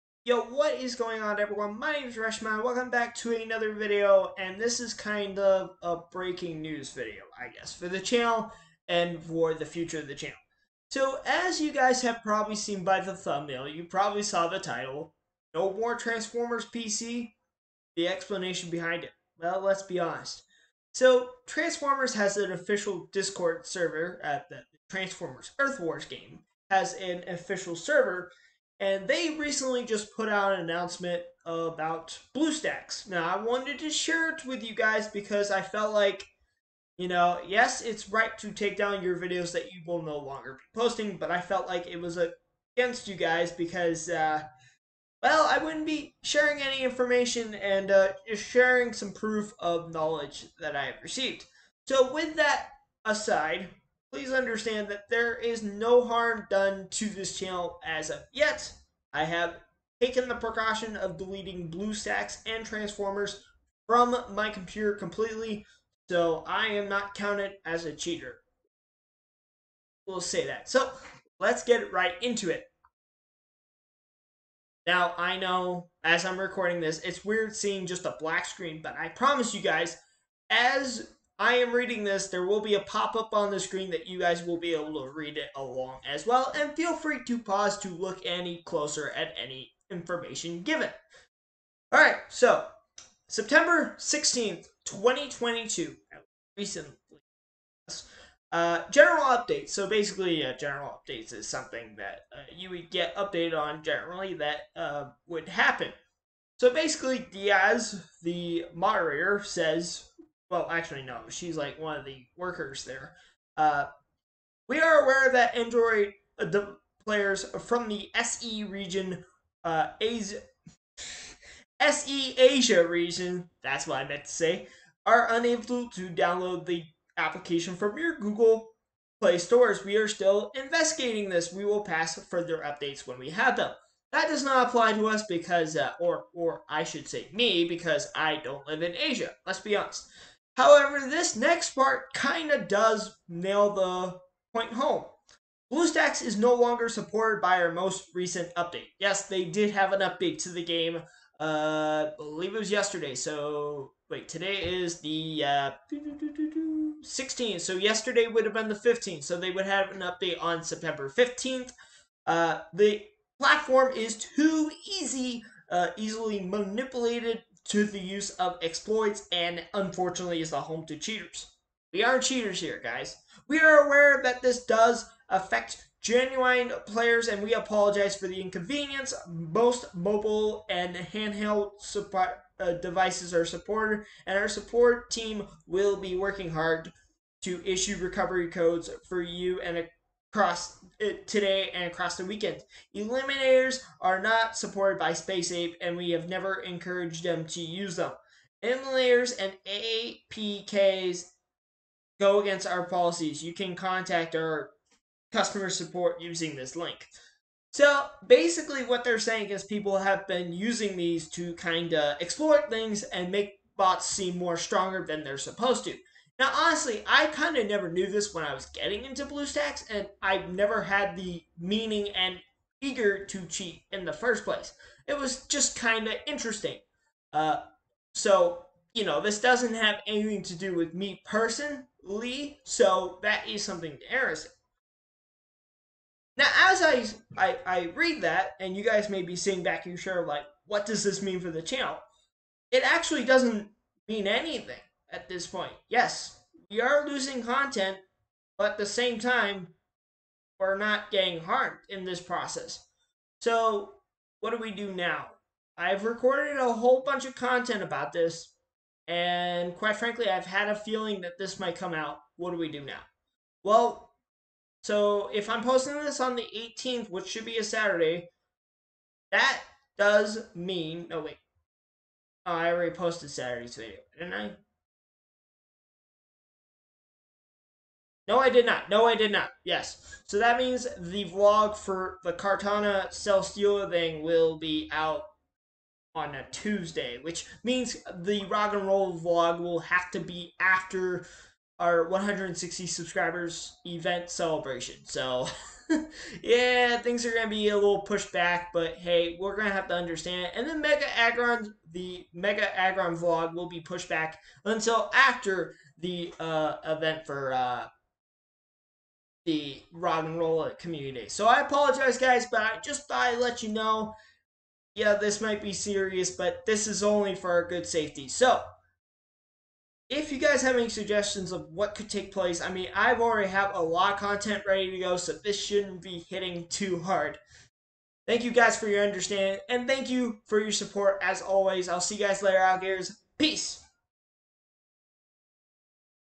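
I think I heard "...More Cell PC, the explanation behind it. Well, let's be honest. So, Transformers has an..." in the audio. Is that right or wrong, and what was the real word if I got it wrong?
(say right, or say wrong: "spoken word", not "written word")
wrong: "Transformers", not "Cell".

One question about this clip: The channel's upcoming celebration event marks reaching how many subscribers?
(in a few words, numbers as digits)
160.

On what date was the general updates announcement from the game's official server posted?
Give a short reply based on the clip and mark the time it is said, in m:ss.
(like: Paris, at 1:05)
September 16th, 2022, at 1:33.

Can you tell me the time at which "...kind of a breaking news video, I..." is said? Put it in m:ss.
0:04.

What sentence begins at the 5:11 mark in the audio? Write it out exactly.
So I apologize, guys, but I just thought I'd let you know.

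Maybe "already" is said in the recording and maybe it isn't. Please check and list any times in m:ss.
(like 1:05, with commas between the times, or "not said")
4:32, 5:23.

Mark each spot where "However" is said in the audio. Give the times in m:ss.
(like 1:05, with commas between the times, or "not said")
2:20.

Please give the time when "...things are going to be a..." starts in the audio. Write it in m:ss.
4:56.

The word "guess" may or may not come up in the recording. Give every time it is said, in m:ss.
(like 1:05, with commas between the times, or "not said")
0:07.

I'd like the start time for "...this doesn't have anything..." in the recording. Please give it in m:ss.
3:49.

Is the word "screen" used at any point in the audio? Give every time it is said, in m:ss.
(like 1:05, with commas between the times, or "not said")
1:18, 1:23.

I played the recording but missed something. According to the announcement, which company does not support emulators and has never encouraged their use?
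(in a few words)
Space Ape.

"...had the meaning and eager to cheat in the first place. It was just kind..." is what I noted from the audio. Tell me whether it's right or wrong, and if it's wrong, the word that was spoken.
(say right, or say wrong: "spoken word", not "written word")
right.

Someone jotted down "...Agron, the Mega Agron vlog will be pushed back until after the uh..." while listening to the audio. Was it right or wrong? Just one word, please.
right.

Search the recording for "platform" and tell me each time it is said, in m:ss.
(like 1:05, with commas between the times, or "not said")
2:43.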